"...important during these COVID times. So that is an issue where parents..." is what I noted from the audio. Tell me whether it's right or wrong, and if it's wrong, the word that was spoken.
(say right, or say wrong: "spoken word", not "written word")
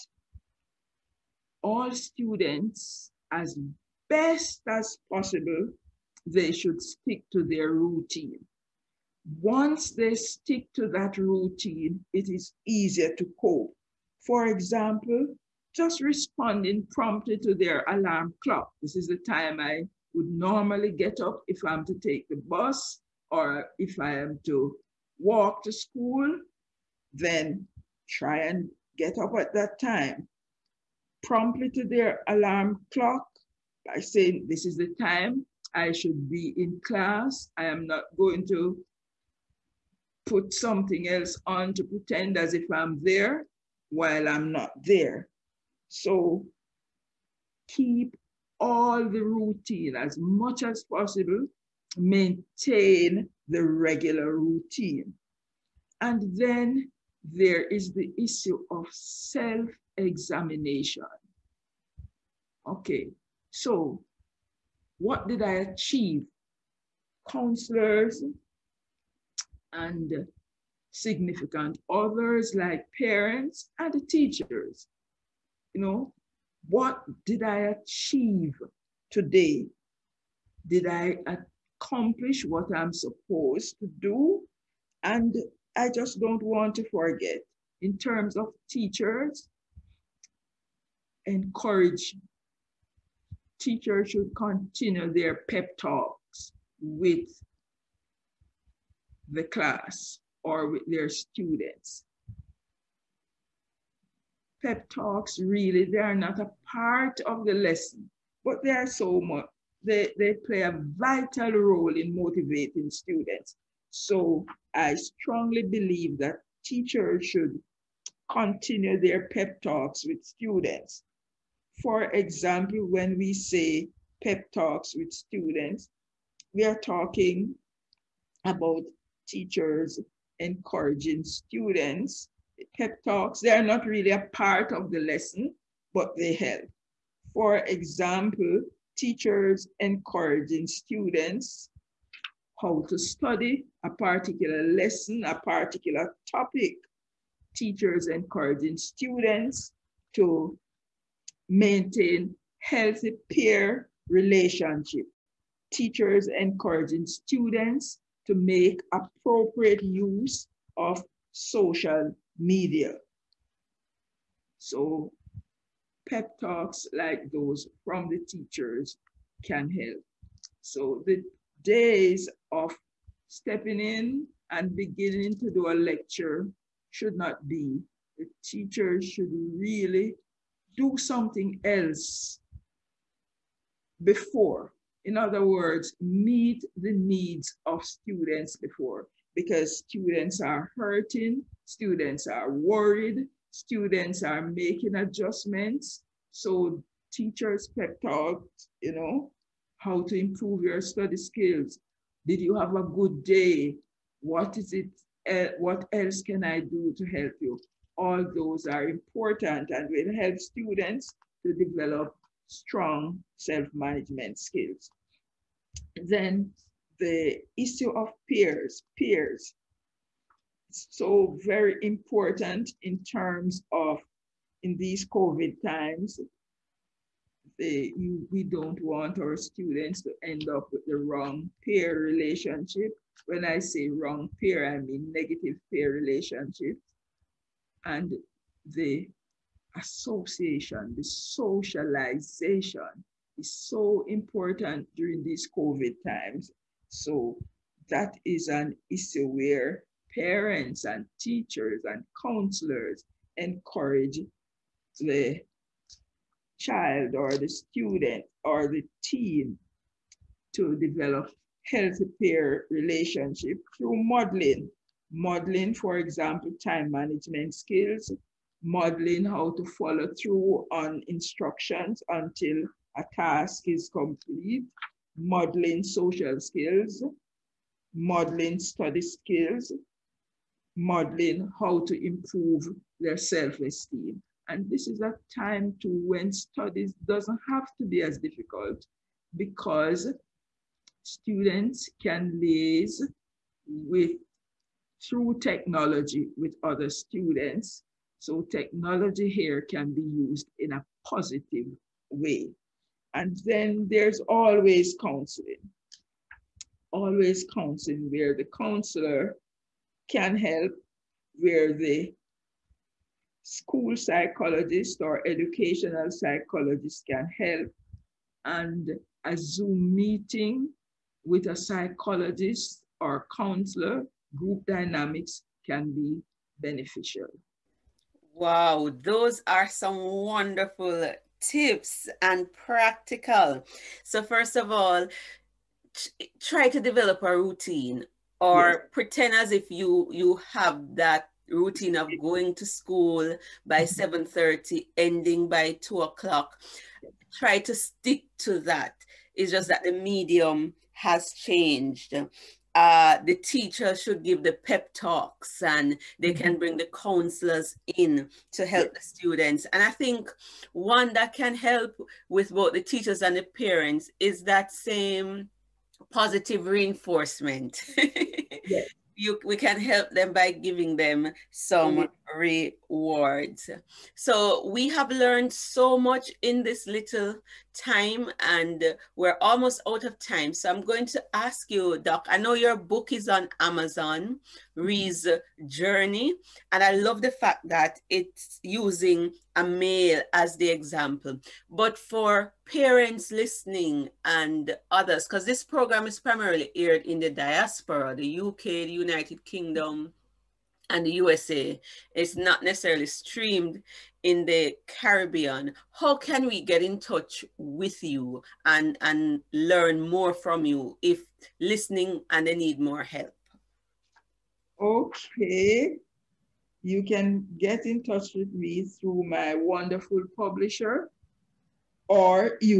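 right.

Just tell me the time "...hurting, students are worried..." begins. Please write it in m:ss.
3:10.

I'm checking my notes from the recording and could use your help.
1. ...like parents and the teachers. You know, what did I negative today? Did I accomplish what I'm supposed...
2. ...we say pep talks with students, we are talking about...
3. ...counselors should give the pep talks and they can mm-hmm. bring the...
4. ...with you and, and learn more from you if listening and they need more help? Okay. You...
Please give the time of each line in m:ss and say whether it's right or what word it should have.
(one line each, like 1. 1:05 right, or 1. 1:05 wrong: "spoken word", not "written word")
1. 1:12 wrong: "achieve", not "negative"
2. 2:03 right
3. 5:53 wrong: "teachers", not "counselors"
4. 6:47 right.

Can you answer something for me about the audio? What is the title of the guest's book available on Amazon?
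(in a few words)
Ree's Journey.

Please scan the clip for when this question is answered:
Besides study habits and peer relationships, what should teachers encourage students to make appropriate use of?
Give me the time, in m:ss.
2:41.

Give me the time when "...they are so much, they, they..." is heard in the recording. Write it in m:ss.
1:48.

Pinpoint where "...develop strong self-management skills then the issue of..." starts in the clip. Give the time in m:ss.
3:31.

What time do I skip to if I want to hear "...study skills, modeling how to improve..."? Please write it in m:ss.
4:38.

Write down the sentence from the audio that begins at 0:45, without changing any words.
So keep all the routine as much as possible, maintain the regular routine.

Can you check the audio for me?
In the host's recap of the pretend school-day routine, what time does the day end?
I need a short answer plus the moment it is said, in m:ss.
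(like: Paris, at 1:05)
2 o'clock, at 5:45.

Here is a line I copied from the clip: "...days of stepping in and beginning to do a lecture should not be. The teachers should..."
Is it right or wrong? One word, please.
right.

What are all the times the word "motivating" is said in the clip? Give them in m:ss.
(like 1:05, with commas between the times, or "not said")
1:52.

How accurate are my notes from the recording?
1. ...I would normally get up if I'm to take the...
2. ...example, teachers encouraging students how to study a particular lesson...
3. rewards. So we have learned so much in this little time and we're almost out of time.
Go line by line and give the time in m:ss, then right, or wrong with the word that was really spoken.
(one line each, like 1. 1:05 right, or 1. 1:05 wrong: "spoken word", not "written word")
1. 0:19 right
2. 2:17 right
3. 6:12 right.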